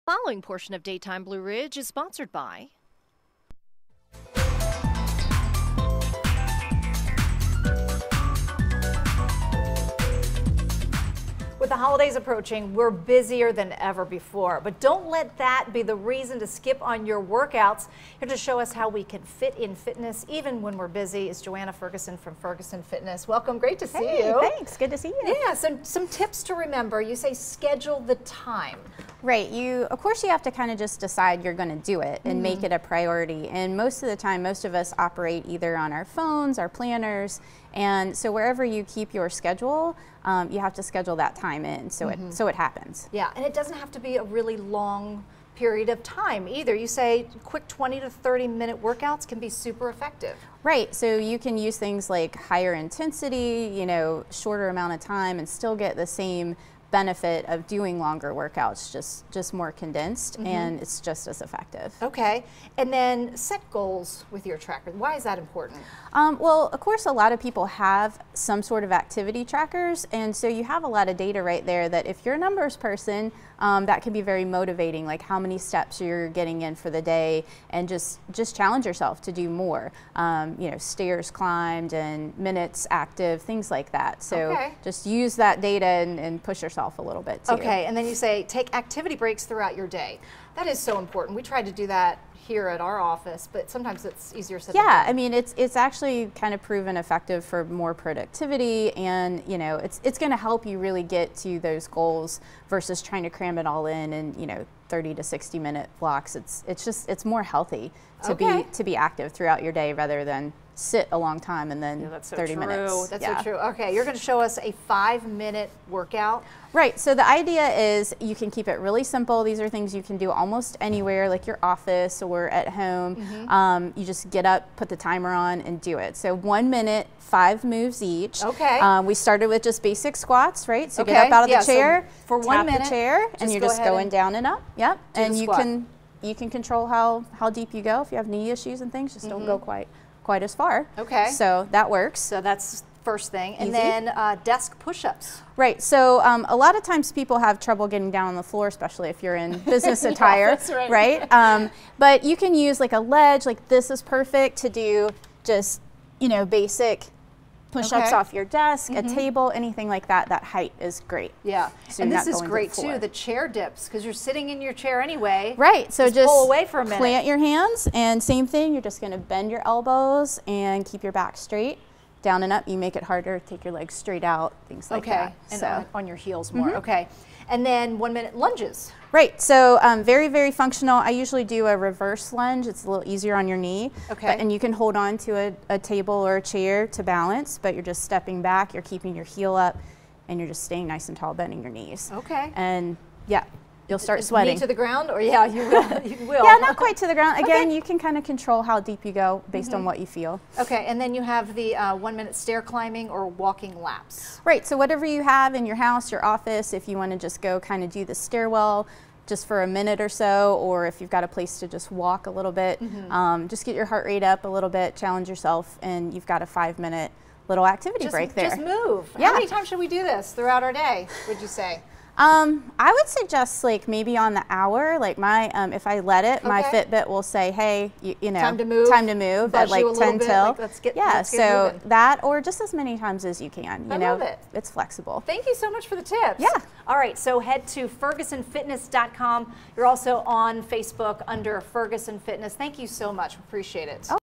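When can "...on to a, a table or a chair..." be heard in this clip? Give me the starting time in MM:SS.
03:04.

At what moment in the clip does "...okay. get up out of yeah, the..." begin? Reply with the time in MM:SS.
02:11.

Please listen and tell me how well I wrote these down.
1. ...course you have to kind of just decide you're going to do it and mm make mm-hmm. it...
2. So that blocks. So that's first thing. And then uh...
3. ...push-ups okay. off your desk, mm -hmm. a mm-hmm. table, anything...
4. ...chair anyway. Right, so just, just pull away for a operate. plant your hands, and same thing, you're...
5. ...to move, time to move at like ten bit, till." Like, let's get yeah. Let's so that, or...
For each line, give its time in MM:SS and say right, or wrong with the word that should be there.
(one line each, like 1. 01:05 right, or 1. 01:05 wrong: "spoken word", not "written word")
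1. 00:29 right
2. 02:21 wrong: "works", not "blocks"
3. 02:37 right
4. 02:44 wrong: "minute", not "operate"
5. 03:48 right.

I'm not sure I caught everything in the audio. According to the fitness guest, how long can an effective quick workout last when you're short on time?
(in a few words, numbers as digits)
20 to 30 minutes.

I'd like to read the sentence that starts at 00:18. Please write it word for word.
Here to show us how we can fit in fitness even when we're busy is Johanna Ferguson from Ferguson Fitness.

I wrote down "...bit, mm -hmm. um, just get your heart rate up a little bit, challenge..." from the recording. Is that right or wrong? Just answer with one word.
right.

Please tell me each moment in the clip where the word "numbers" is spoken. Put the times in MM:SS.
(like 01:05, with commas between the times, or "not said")
01:12.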